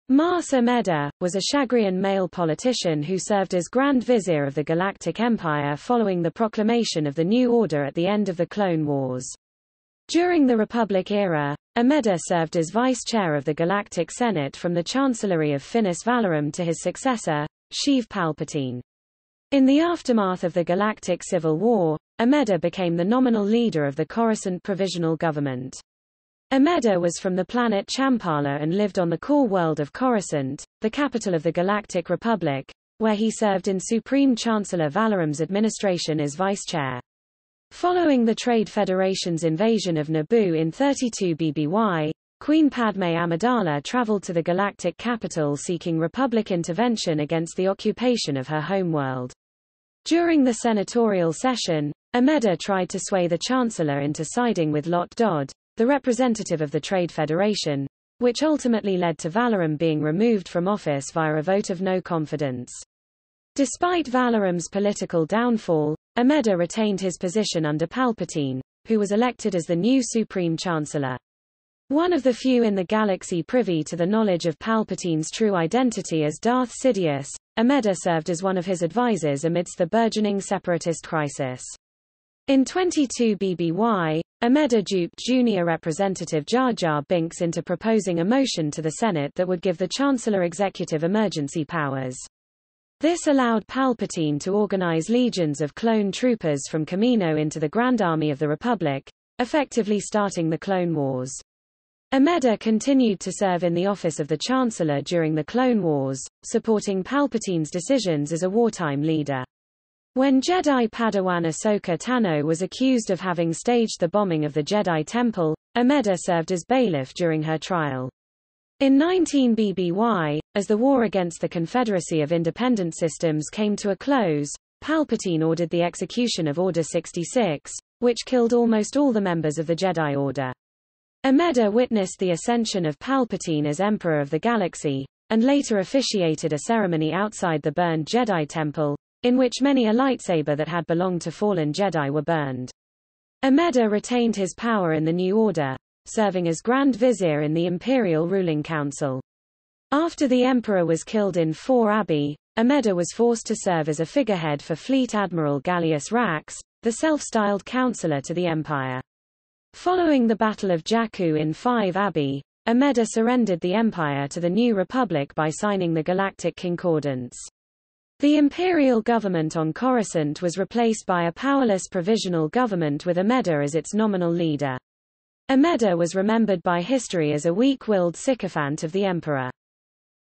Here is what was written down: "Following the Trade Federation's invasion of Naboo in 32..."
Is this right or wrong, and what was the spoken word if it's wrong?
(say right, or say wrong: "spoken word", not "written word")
right.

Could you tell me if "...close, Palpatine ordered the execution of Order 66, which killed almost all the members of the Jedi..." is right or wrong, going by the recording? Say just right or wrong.
right.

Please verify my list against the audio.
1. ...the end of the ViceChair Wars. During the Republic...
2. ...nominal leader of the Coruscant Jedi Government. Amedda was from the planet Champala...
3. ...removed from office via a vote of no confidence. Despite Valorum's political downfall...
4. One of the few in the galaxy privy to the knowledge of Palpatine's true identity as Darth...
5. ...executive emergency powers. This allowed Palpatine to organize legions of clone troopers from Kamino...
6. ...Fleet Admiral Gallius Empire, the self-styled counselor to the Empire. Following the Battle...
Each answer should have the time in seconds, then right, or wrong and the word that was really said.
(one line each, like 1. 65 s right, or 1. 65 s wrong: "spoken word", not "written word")
1. 7 s wrong: "Clone", not "ViceChair"
2. 23 s wrong: "Provisional", not "Jedi"
3. 60 s right
4. 71 s right
5. 90 s right
6. 154 s wrong: "Rax", not "Empire".